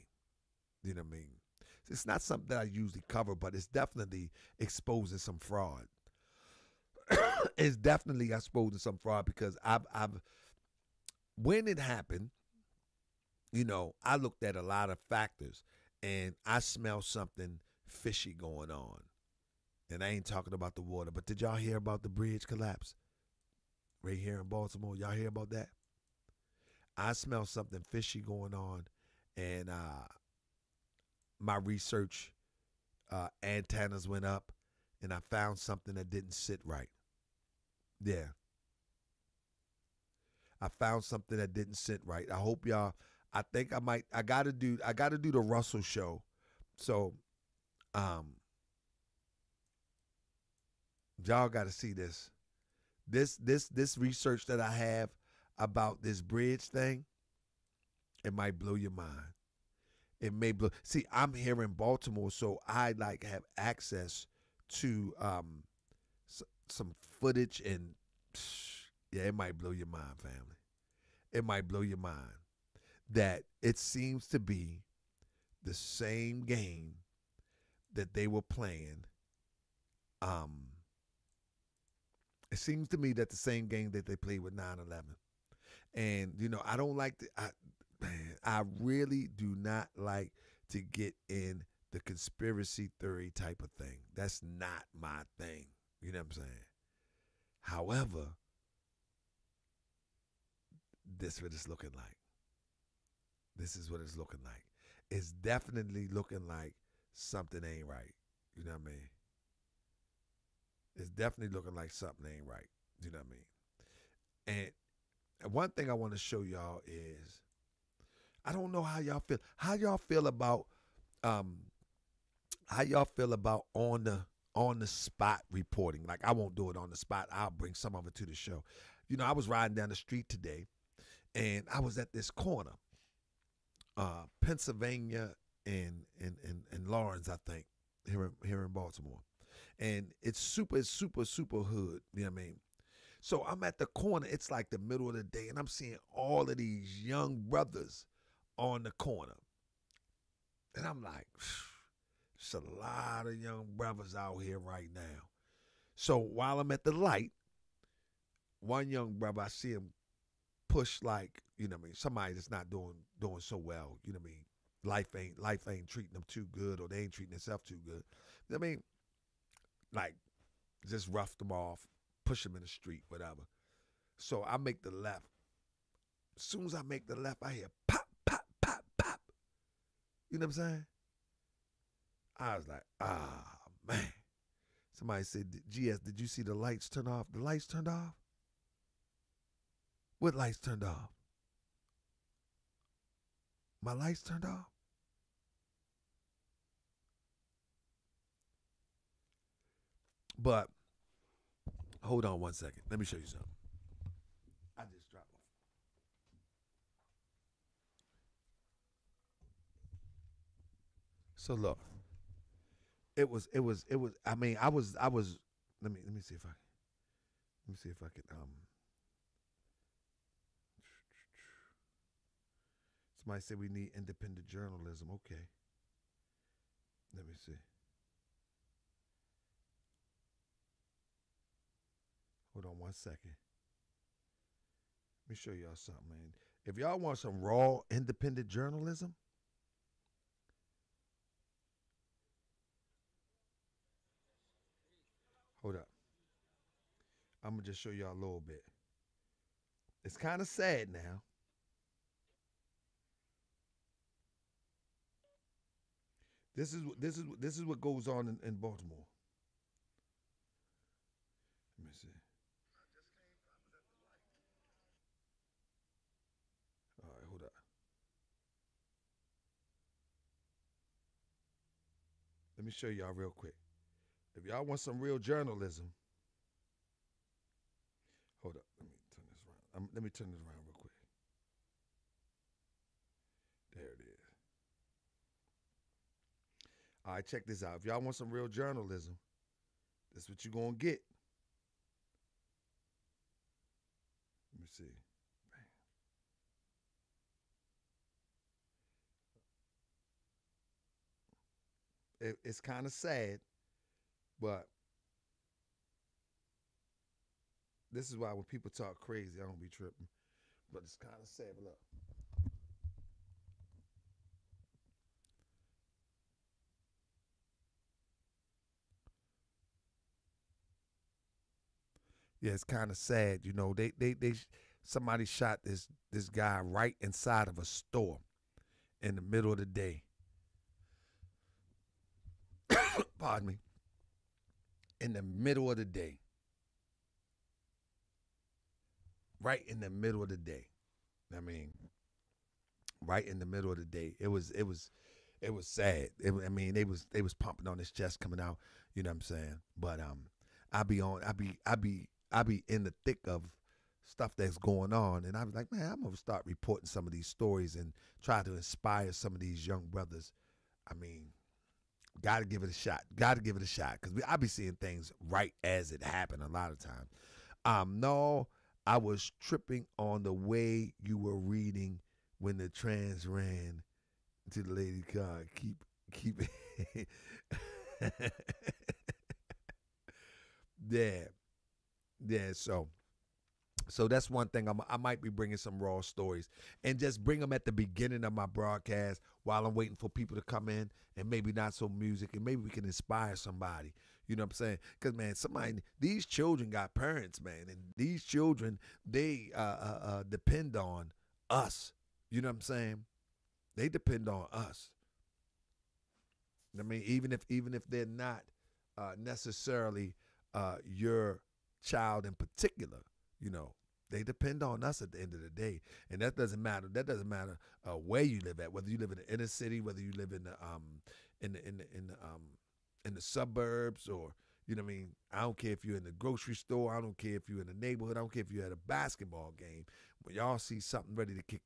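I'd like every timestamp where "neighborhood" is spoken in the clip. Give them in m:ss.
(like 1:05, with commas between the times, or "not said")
7:07.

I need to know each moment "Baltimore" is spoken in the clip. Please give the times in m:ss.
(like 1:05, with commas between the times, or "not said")
0:24, 1:01, 2:18, 4:18.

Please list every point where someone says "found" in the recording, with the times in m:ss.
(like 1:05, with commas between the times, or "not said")
0:35, 0:40.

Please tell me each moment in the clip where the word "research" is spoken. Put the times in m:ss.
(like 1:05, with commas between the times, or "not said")
0:31, 0:53.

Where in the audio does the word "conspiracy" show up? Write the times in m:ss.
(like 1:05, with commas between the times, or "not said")
1:32.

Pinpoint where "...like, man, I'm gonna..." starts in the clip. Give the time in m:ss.
5:55.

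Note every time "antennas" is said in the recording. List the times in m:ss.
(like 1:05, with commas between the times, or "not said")
0:33.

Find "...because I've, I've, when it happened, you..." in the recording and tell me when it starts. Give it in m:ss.
0:09.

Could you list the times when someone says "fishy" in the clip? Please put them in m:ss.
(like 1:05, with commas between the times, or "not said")
0:17, 0:27.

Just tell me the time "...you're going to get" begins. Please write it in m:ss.
4:50.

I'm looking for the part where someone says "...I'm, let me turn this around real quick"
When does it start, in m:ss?
4:39.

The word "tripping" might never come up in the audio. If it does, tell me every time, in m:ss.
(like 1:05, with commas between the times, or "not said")
5:09, 6:09.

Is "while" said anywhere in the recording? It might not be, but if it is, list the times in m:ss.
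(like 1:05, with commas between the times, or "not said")
2:36, 6:29.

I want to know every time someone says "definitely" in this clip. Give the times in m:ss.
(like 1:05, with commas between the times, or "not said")
0:03, 0:07, 1:45, 1:51.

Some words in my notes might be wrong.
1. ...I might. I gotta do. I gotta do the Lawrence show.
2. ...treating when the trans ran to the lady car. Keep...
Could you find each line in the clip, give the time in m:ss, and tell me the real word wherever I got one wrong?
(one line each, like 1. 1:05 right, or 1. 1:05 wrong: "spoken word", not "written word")
1. 0:43 wrong: "Russell", not "Lawrence"
2. 6:11 wrong: "reading", not "treating".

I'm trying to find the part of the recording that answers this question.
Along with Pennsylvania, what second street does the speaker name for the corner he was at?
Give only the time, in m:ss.
2:16.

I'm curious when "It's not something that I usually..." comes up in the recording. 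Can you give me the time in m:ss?
0:01.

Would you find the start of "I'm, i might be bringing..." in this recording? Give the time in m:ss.
6:24.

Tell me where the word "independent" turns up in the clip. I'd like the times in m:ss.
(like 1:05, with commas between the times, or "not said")
3:43, 3:57.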